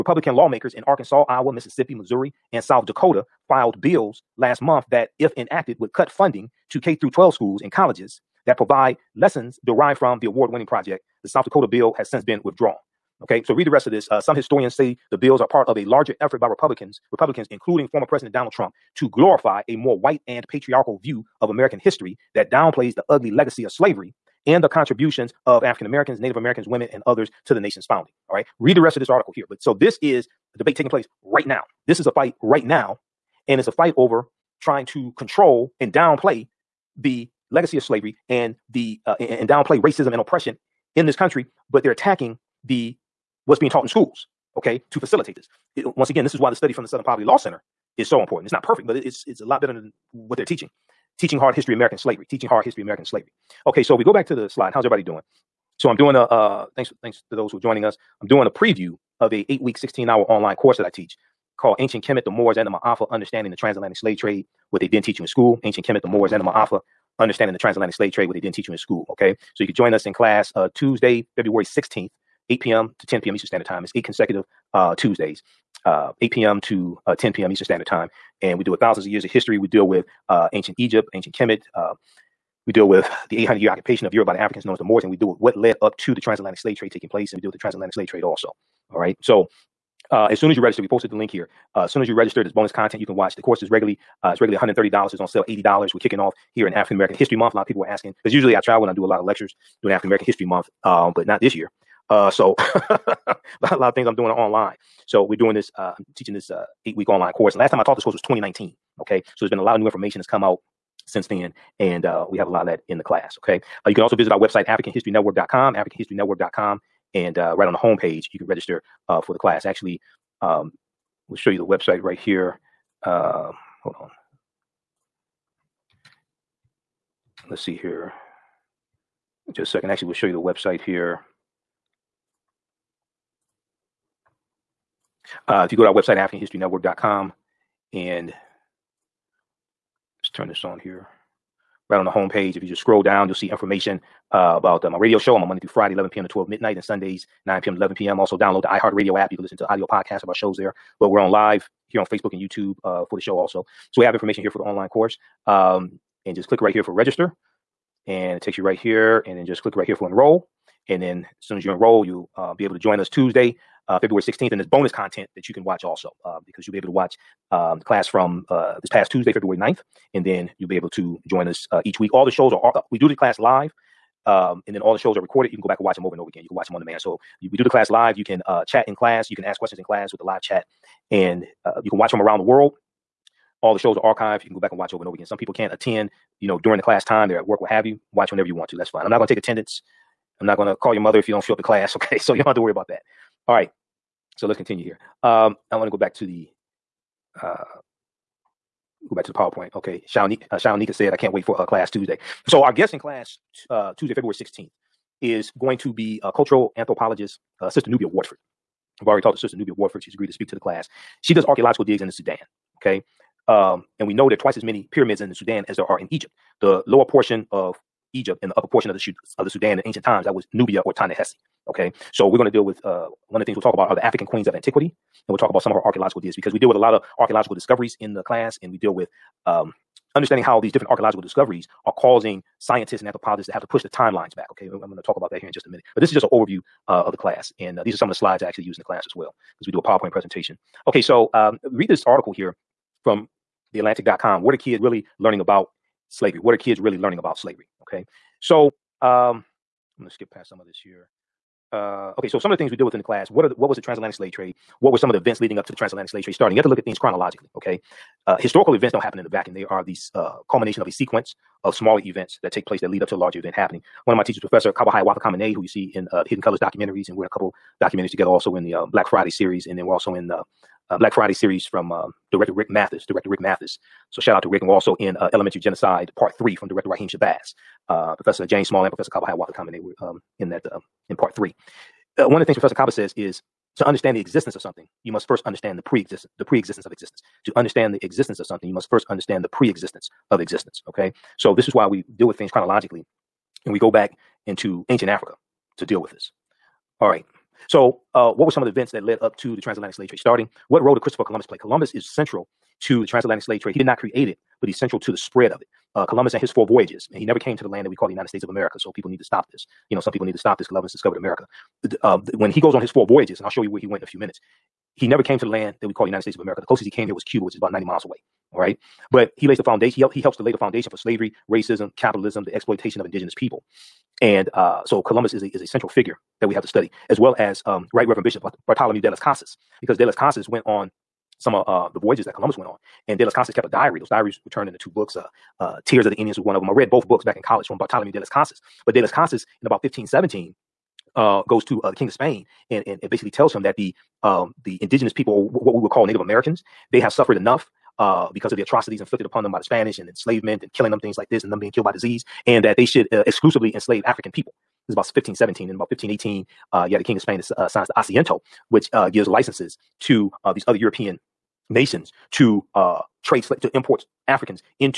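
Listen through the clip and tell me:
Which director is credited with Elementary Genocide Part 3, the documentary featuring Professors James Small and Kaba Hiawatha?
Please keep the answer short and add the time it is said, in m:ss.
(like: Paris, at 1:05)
Raheem Shabazz, at 4:36.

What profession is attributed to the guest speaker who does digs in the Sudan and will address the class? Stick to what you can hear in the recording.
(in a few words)
cultural anthropologist.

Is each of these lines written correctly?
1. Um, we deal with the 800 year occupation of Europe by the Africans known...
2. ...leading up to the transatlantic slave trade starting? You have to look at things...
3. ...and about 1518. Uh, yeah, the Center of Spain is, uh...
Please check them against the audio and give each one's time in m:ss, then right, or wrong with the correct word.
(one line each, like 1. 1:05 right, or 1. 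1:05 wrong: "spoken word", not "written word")
1. 1:21 right
2. 4:15 right
3. 5:55 wrong: "King", not "Center".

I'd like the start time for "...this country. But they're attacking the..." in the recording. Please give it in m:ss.
0:41.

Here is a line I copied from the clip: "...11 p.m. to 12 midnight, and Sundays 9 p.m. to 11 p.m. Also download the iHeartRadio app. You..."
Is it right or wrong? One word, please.
right.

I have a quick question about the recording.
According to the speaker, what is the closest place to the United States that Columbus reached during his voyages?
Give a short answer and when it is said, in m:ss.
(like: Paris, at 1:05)
Cuba, at 5:16.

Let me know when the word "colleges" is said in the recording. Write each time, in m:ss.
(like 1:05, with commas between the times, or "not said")
0:07, 5:37.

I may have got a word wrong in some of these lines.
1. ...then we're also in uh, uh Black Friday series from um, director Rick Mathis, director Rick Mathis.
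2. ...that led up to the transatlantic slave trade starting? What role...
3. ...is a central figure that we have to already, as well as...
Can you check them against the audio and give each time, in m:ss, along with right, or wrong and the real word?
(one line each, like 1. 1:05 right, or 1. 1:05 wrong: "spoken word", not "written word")
1. 4:29 right
2. 4:58 right
3. 5:25 wrong: "study", not "already".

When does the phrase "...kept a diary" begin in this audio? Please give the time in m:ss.
5:33.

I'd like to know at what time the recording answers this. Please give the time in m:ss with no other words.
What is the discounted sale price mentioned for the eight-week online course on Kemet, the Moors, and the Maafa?
1:35.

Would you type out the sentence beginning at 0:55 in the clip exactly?
So I'm doing a uh, thanks thanks to those who are joining us.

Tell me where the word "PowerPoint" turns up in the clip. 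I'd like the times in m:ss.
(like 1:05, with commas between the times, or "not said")
3:19, 3:59.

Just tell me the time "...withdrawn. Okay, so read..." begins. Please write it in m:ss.
0:12.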